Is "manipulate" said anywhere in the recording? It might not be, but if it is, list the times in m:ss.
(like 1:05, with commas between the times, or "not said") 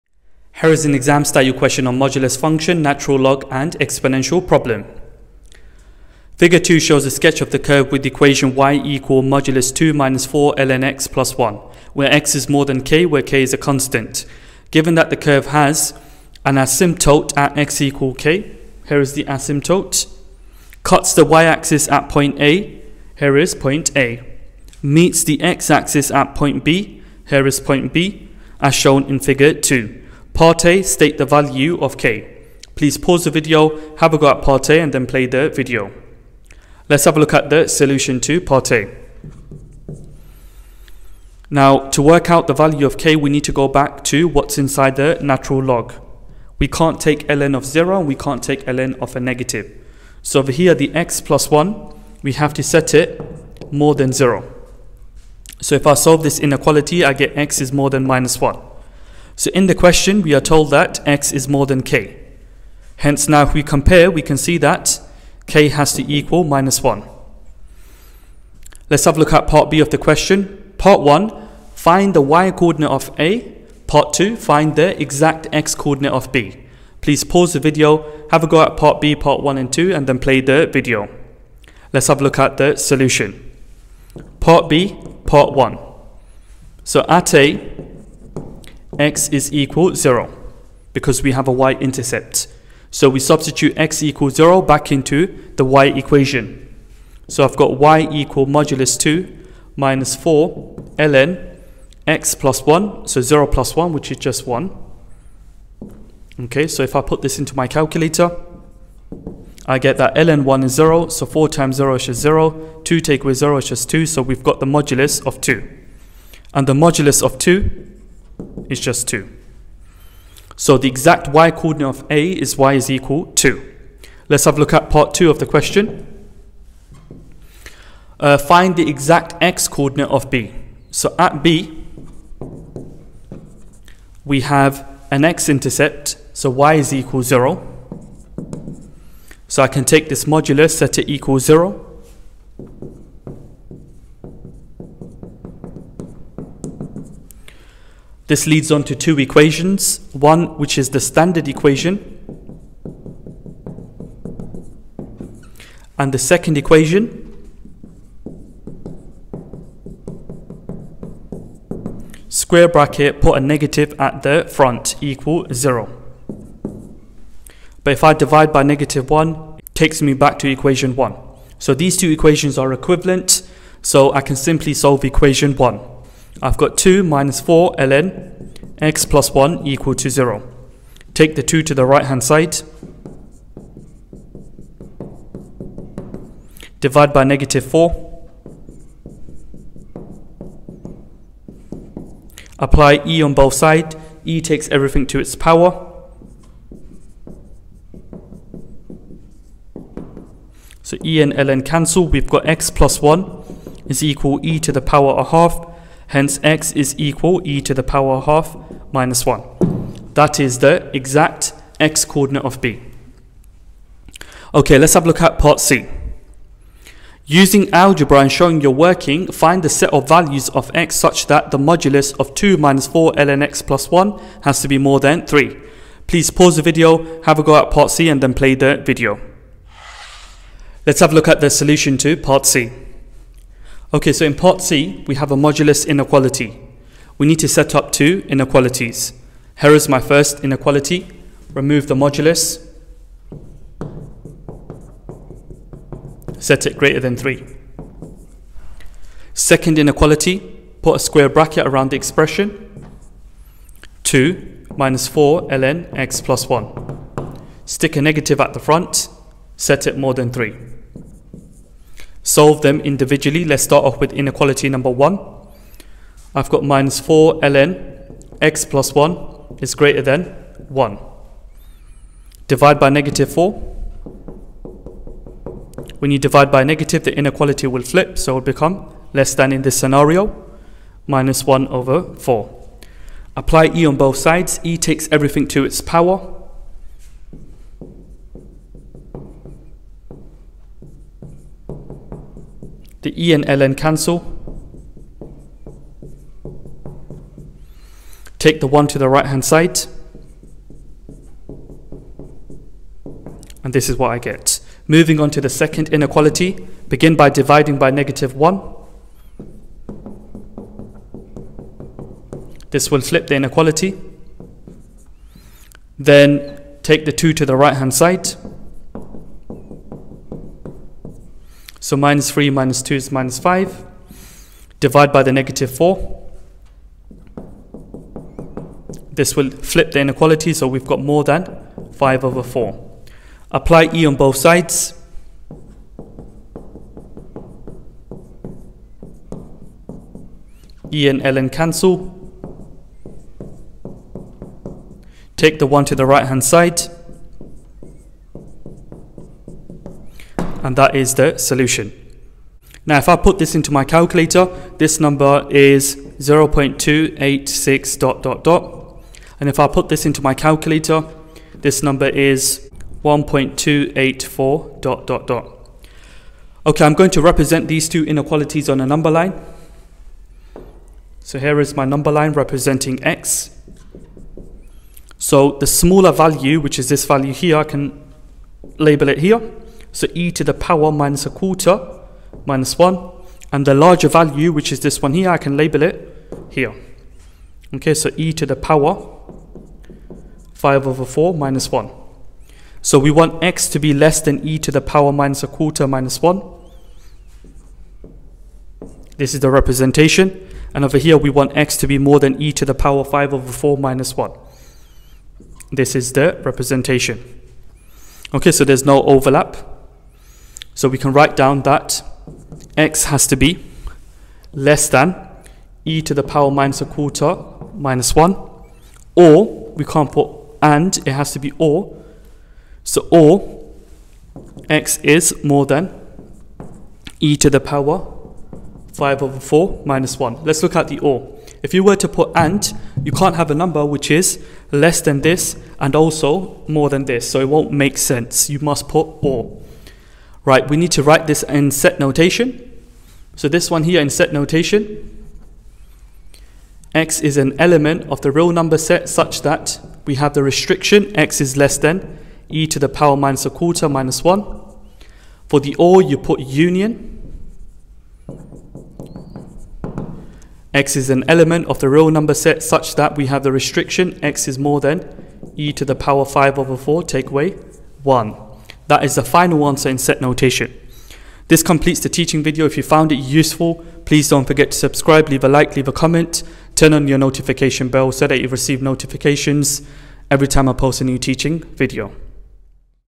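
not said.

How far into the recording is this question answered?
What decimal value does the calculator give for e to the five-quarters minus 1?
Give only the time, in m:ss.
6:03.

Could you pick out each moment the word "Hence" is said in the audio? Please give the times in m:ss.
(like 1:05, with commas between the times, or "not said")
1:02, 3:26.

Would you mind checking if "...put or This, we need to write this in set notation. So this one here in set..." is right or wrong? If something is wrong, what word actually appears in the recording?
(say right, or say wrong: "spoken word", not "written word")
wrong: "Right", not "This".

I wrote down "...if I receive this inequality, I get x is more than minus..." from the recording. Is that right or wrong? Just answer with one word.
wrong.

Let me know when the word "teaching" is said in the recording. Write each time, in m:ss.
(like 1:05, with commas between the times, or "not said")
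7:52, 8:01.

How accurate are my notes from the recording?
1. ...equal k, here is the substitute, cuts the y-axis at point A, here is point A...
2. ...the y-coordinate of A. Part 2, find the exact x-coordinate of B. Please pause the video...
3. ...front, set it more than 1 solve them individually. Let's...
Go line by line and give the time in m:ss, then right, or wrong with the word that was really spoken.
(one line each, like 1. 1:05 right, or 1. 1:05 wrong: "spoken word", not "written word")
1. 0:17 wrong: "asymptote", not "substitute"
2. 1:12 right
3. 4:18 wrong: "3", not "1".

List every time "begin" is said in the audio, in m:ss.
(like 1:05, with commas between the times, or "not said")
5:06.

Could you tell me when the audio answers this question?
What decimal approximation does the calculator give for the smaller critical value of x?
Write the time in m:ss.
5:56.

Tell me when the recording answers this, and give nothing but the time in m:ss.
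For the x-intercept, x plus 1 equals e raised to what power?
3:24.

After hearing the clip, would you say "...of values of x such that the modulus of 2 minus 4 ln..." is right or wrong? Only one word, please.
right.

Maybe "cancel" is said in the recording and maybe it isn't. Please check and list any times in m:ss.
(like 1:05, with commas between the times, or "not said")
3:21, 4:53, 5:41.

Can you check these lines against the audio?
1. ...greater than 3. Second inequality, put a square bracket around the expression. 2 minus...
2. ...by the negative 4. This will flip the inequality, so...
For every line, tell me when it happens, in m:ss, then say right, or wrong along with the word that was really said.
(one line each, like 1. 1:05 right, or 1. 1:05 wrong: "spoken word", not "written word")
1. 4:06 right
2. 5:25 right.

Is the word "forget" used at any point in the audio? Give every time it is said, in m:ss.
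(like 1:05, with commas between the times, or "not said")
7:54.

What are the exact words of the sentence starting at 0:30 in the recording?
Part A, state the value of k.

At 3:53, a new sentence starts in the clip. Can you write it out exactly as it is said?
Okay, so in part C, we have a modulus inequality.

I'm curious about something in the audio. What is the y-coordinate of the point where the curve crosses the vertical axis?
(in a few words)
2.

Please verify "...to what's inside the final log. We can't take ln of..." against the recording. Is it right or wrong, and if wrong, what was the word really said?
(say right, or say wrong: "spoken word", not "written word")
wrong: "natural", not "final".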